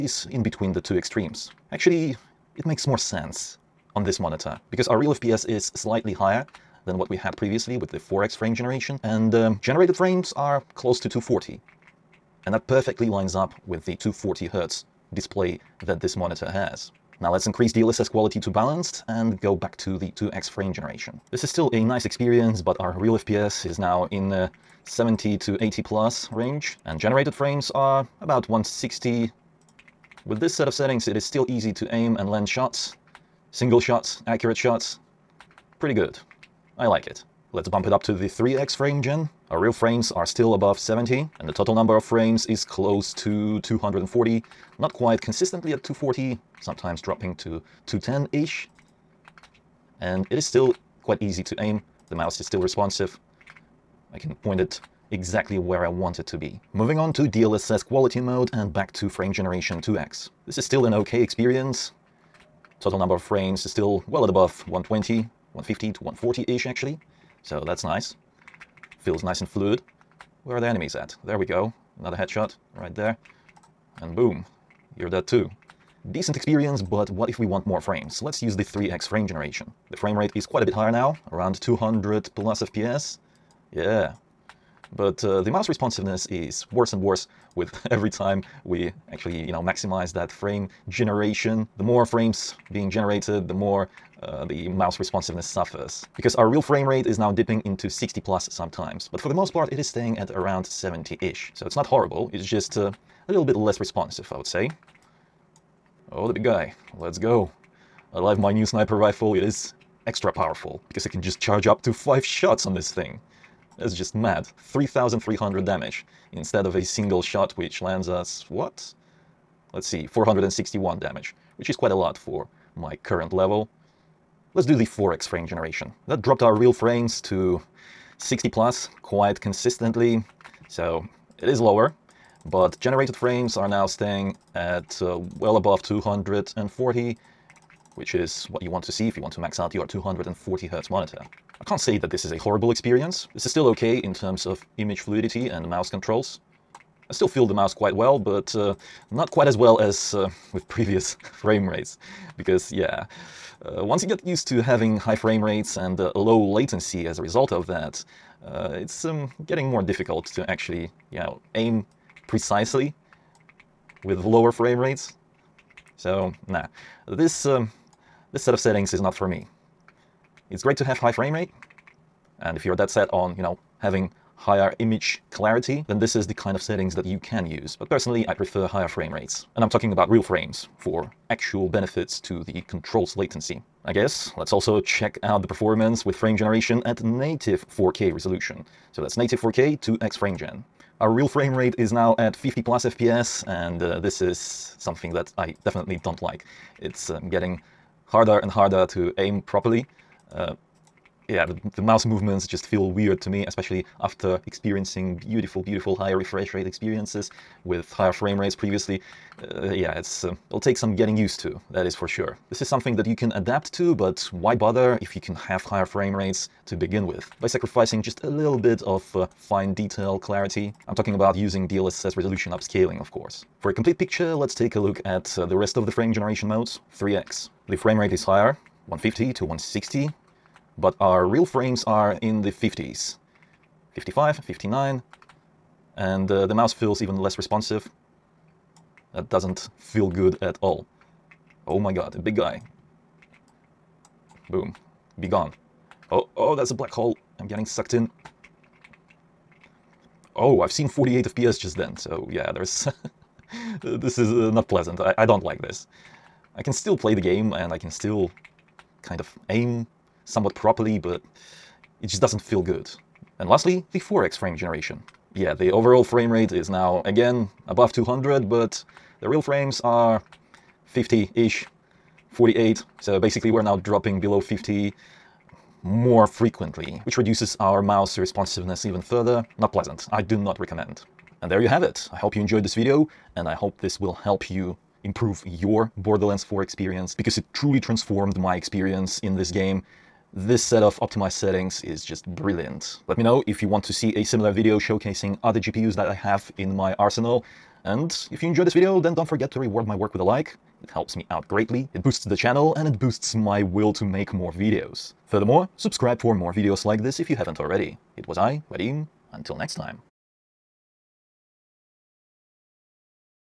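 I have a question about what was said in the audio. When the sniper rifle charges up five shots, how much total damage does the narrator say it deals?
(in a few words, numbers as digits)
3,300.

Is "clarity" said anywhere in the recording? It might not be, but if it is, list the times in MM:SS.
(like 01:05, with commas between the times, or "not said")
02:55, 03:40.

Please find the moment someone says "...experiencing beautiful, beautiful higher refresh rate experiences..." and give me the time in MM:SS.
03:24.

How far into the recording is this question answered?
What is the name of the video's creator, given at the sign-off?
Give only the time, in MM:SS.
05:08.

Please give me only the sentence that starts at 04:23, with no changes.
And lastly, the 4x frame generation.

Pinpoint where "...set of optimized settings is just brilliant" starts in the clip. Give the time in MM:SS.
04:50.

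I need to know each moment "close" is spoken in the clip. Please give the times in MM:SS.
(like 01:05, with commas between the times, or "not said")
00:10, 00:42.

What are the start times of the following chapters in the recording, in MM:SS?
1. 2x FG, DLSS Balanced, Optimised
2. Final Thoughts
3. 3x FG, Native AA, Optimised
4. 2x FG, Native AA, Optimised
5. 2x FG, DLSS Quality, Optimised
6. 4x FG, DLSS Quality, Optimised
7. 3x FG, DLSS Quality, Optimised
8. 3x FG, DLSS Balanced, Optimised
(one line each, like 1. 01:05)
1. 00:16
2. 04:40
3. 03:46
4. 03:08
5. 00:56
6. 02:04
7. 01:15
8. 00:37.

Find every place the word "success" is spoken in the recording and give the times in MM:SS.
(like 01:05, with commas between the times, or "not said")
not said.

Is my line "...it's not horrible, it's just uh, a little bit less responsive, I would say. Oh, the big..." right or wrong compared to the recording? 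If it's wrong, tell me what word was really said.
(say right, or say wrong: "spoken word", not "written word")
right.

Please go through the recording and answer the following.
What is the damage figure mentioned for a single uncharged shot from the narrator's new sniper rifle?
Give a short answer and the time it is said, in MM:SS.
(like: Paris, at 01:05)
461, at 02:00.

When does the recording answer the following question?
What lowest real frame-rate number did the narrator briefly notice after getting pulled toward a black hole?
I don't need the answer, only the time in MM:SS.
04:10.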